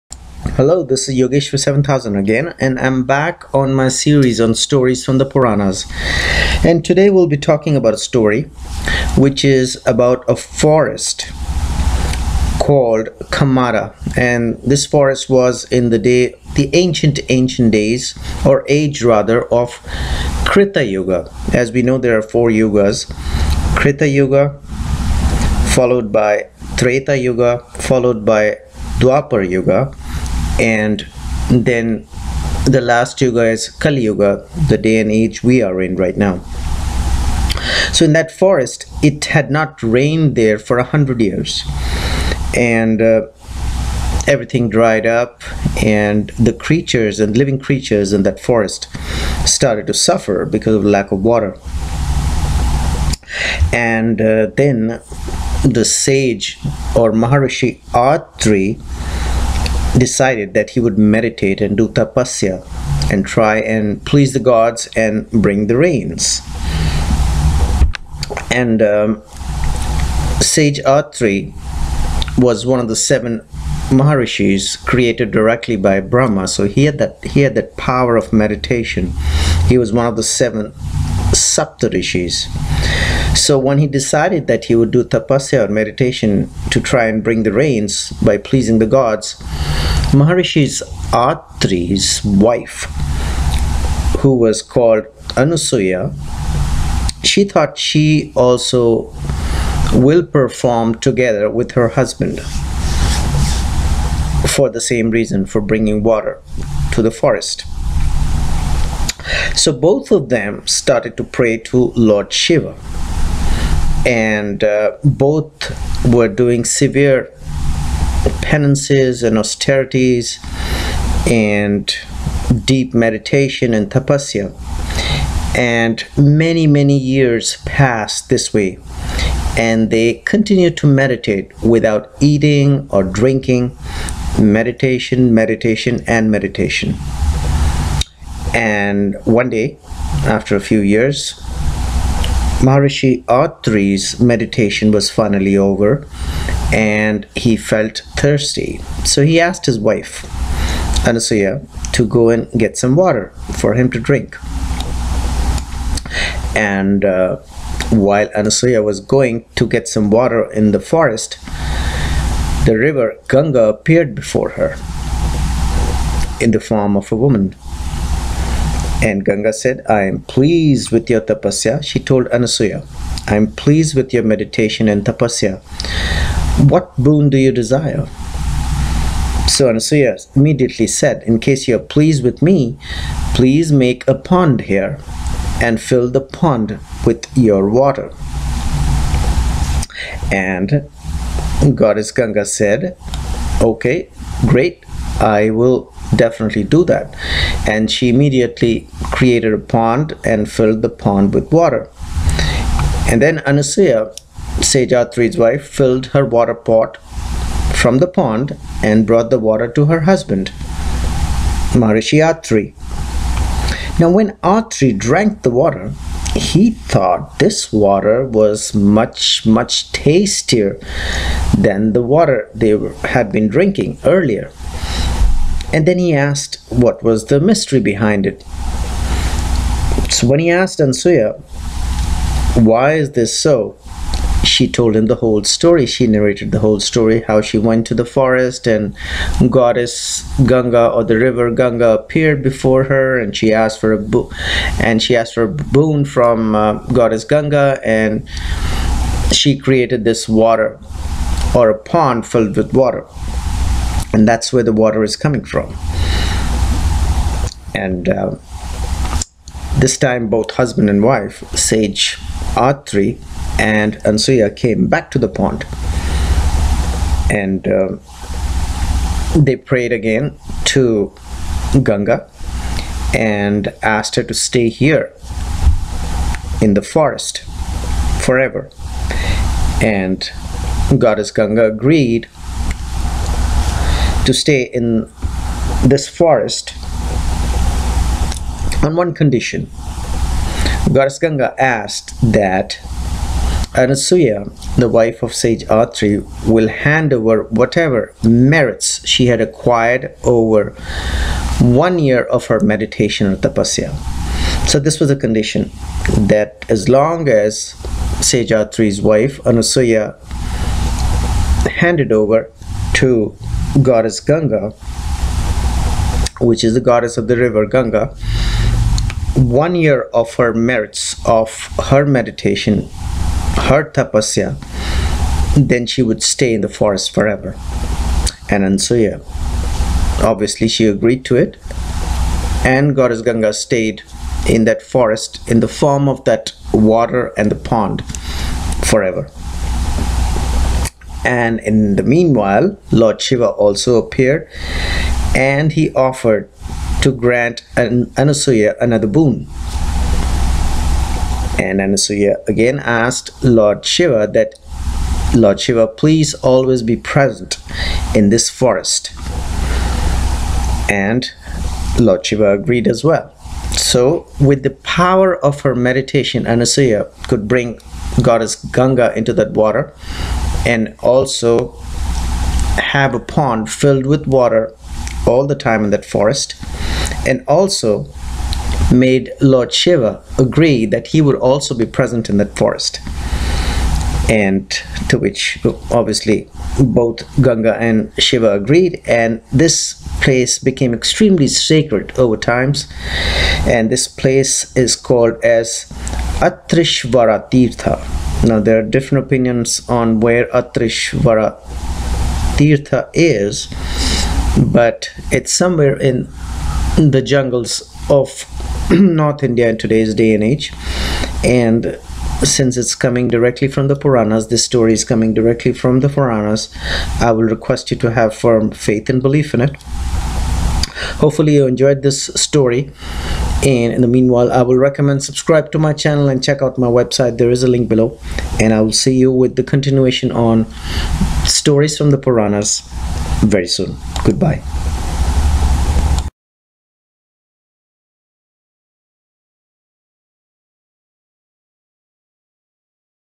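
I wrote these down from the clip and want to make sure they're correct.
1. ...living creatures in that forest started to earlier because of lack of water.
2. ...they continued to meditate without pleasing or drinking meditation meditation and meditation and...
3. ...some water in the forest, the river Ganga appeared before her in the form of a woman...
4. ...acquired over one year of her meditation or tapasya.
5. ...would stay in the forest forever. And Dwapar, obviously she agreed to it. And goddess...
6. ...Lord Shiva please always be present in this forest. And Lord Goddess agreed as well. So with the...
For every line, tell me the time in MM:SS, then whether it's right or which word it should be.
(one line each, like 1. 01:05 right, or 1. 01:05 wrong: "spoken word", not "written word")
1. 00:47 wrong: "suffer", not "earlier"
2. 02:09 wrong: "eating", not "pleasing"
3. 02:39 right
4. 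04:59 right
5. 05:26 wrong: "Ansuya", not "Dwapar"
6. 05:55 wrong: "Shiva", not "Goddess".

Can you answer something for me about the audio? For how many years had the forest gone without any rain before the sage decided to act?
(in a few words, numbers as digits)
100.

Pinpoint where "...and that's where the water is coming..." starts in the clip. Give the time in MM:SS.
04:14.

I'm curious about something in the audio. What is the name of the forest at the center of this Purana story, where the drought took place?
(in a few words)
Kamara.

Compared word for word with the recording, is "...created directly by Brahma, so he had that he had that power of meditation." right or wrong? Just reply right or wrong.
right.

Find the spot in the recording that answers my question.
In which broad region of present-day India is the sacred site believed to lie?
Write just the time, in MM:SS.
06:48.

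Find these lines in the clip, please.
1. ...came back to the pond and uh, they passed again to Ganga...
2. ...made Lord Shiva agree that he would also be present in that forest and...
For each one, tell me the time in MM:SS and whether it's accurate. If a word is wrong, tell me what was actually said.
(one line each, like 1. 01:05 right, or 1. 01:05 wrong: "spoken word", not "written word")
1. 04:24 wrong: "prayed", not "passed"
2. 06:18 right.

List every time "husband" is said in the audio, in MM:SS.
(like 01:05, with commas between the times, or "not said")
01:41, 03:30, 04:20.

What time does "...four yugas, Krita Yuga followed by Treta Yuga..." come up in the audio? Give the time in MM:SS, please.
00:22.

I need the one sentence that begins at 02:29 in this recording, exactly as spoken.
So he asked his wife, Anasuya, to go and get some water for him to drink.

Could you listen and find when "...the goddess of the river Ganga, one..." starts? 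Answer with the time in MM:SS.
05:16.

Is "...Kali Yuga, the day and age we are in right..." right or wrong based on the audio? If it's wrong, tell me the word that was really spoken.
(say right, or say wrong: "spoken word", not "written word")
right.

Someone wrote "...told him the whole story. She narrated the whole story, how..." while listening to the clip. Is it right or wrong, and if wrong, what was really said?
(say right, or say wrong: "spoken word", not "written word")
right.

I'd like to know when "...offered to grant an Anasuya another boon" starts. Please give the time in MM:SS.
05:45.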